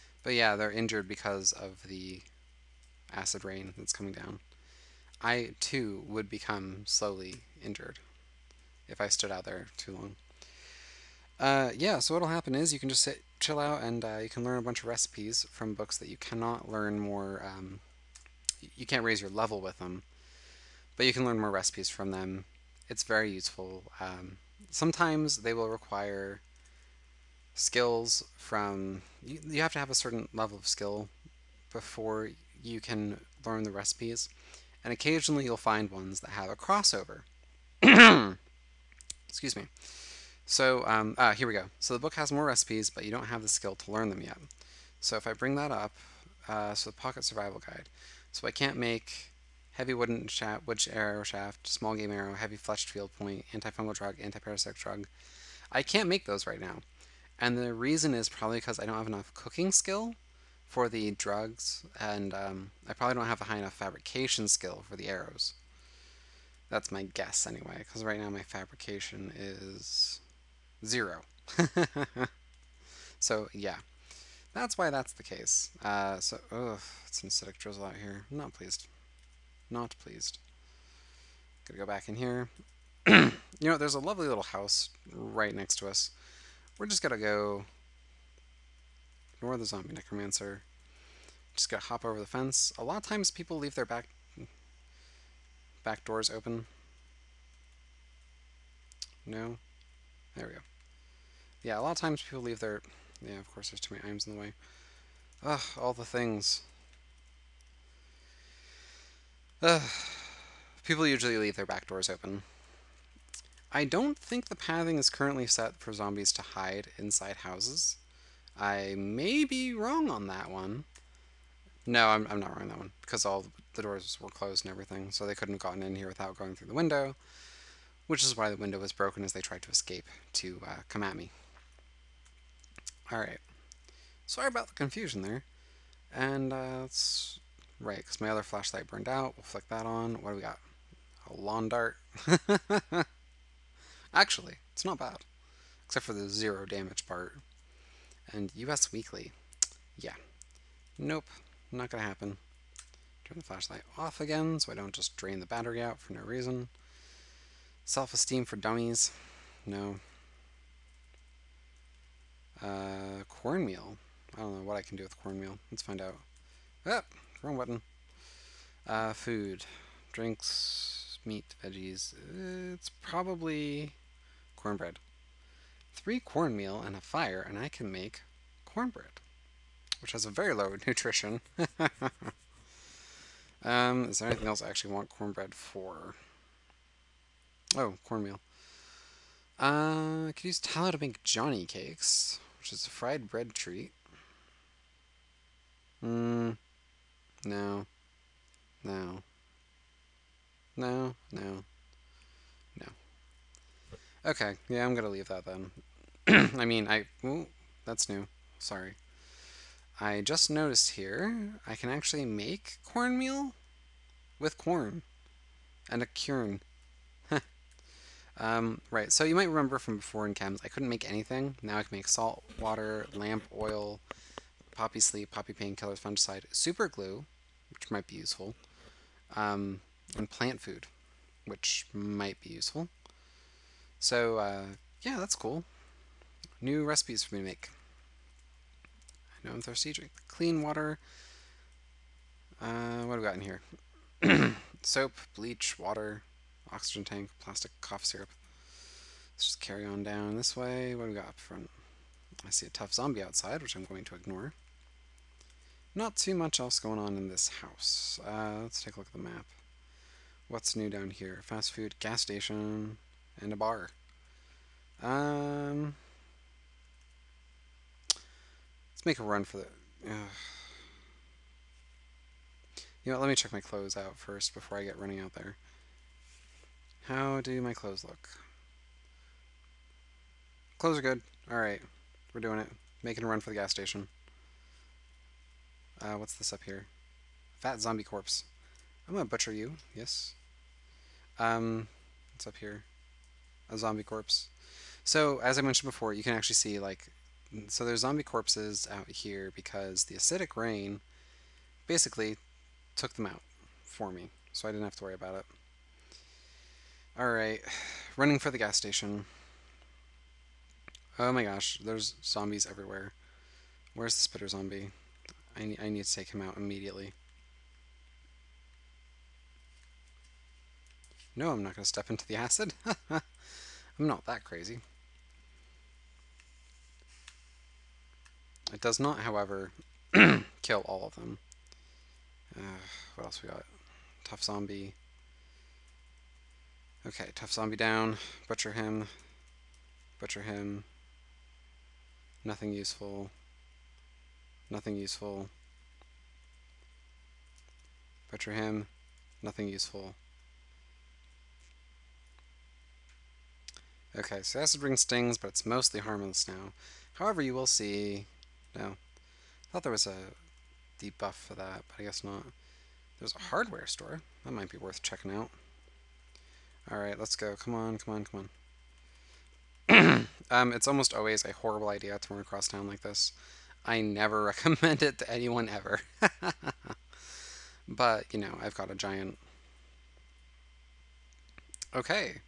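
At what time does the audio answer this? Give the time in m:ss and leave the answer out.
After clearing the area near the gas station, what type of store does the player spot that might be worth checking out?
6:03.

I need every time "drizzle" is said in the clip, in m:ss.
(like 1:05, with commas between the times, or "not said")
1:17.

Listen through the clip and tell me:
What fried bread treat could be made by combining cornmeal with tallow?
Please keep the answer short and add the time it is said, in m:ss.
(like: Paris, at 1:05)
Johnny cakes, at 3:11.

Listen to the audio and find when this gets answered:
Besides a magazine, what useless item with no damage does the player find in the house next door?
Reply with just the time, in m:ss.
2:21.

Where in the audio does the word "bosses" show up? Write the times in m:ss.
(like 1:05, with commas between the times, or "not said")
not said.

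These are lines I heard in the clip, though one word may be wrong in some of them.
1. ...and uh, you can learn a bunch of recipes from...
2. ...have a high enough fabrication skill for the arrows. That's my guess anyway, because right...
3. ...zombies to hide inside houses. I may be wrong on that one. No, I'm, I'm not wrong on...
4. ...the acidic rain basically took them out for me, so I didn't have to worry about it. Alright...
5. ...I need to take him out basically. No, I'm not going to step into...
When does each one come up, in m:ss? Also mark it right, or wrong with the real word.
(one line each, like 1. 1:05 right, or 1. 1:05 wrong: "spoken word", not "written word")
1. 0:13 right
2. 1:03 right
3. 1:55 right
4. 5:00 right
5. 5:15 wrong: "immediately", not "basically".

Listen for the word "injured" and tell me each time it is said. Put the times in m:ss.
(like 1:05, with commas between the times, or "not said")
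0:00, 0:07.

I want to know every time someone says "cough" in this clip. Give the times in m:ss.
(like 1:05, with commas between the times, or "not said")
4:07.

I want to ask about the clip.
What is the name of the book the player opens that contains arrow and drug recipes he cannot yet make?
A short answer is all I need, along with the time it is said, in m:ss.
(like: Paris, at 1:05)
Pocket Survival Guide, at 0:46.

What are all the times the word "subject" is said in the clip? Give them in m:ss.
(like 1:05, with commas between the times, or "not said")
not said.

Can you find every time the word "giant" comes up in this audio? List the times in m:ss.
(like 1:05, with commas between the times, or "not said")
6:18.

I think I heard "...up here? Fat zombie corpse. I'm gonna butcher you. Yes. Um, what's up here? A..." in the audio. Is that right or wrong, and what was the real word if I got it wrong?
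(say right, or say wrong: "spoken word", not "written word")
right.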